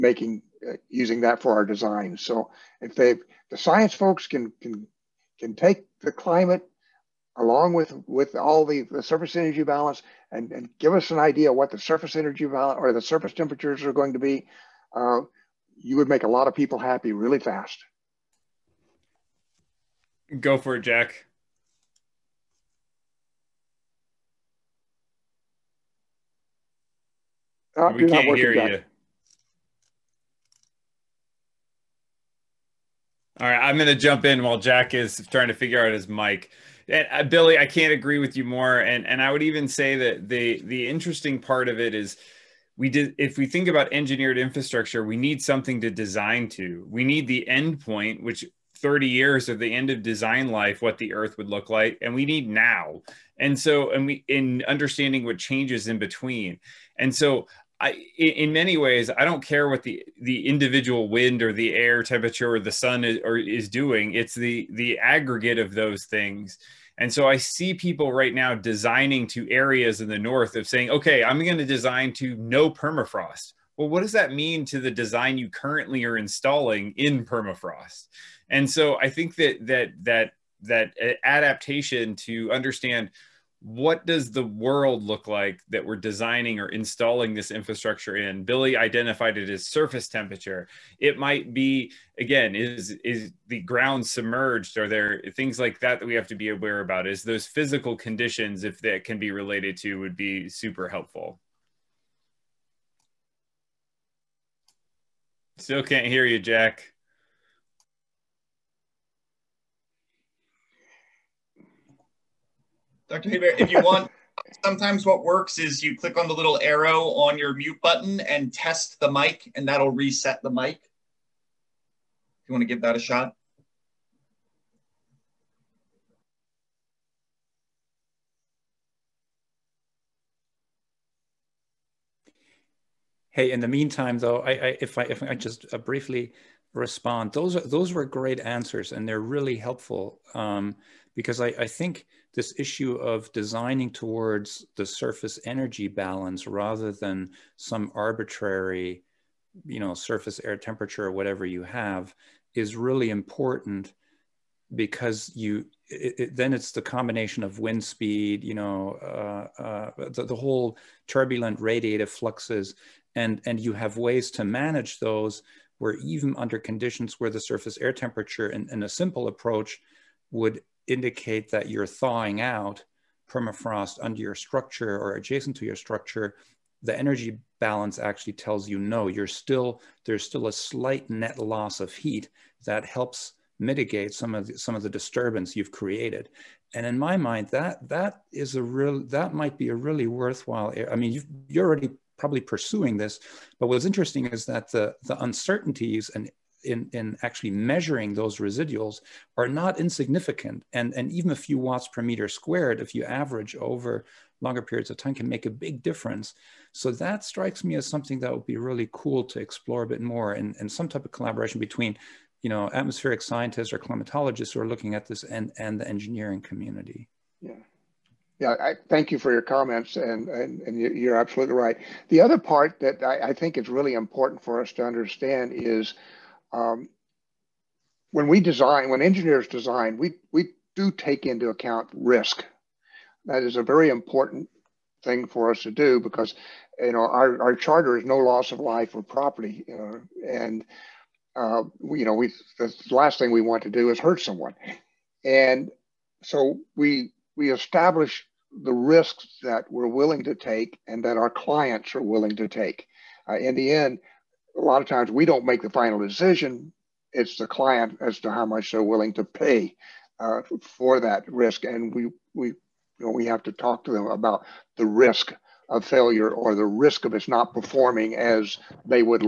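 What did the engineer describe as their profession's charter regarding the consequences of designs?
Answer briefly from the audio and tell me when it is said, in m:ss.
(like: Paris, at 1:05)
no loss of life or property, at 3:58.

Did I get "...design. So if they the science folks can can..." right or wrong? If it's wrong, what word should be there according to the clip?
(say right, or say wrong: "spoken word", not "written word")
right.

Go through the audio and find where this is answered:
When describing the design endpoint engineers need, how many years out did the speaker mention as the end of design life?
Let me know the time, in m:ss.
0:48.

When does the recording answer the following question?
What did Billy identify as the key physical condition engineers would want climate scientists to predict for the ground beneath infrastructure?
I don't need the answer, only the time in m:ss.
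1:29.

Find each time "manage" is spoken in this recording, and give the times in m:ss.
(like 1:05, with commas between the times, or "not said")
2:44.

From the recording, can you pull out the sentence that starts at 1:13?
Well, what does that mean to the design you currently are installing in permafrost?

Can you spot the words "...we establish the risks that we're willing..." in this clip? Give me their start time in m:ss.
4:07.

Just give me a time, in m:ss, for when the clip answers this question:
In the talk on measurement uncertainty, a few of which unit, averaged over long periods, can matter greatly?
3:21.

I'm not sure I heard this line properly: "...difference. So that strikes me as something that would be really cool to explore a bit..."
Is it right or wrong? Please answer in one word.
right.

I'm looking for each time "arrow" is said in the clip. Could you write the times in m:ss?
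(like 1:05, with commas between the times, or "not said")
1:56.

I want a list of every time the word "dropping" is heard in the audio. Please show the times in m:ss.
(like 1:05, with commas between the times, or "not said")
not said.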